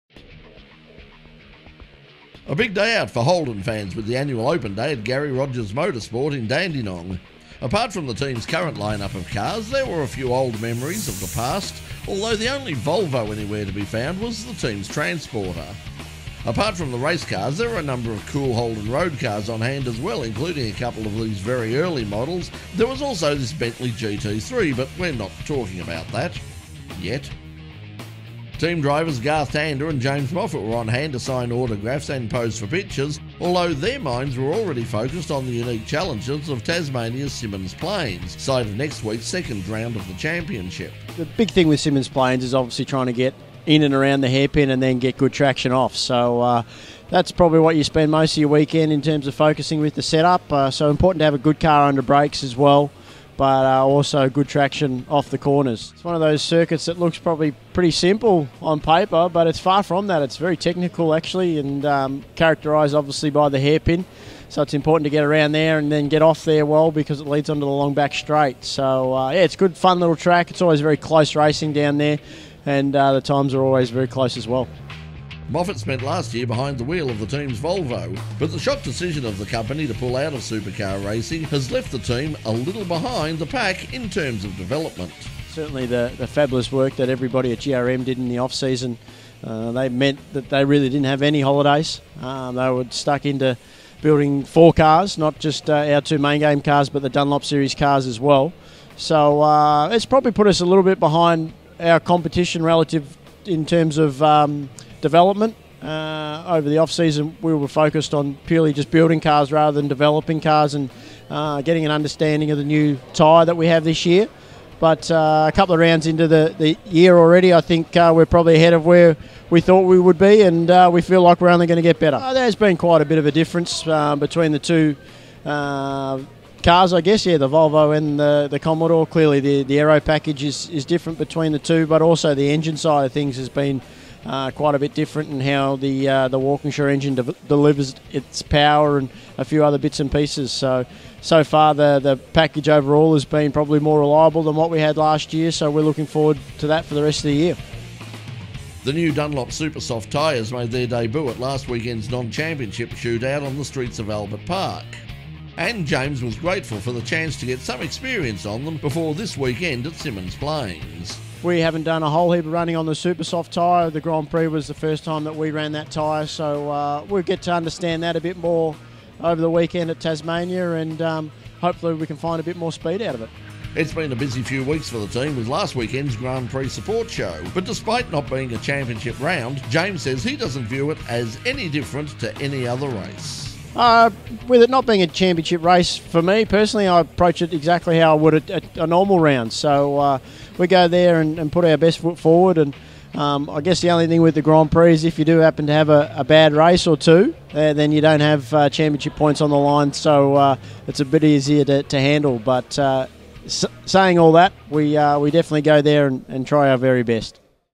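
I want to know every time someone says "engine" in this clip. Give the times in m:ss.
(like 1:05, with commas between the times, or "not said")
2:12, 2:16.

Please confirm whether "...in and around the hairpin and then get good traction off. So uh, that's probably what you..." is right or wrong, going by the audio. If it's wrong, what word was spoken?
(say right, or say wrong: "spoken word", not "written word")
right.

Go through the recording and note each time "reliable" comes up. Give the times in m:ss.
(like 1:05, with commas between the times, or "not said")
2:23.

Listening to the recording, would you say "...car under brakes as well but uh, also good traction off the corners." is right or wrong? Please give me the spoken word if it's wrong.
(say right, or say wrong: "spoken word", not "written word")
right.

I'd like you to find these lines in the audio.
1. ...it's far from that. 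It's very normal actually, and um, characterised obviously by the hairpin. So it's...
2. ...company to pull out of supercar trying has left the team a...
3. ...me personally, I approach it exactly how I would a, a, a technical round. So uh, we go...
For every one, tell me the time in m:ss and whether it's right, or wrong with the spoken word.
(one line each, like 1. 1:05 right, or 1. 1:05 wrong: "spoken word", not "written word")
1. 0:59 wrong: "technical", not "normal"
2. 1:19 wrong: "racing", not "trying"
3. 3:06 wrong: "normal", not "technical".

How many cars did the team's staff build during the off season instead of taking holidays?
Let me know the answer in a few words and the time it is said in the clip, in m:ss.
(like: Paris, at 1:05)
4, at 1:34.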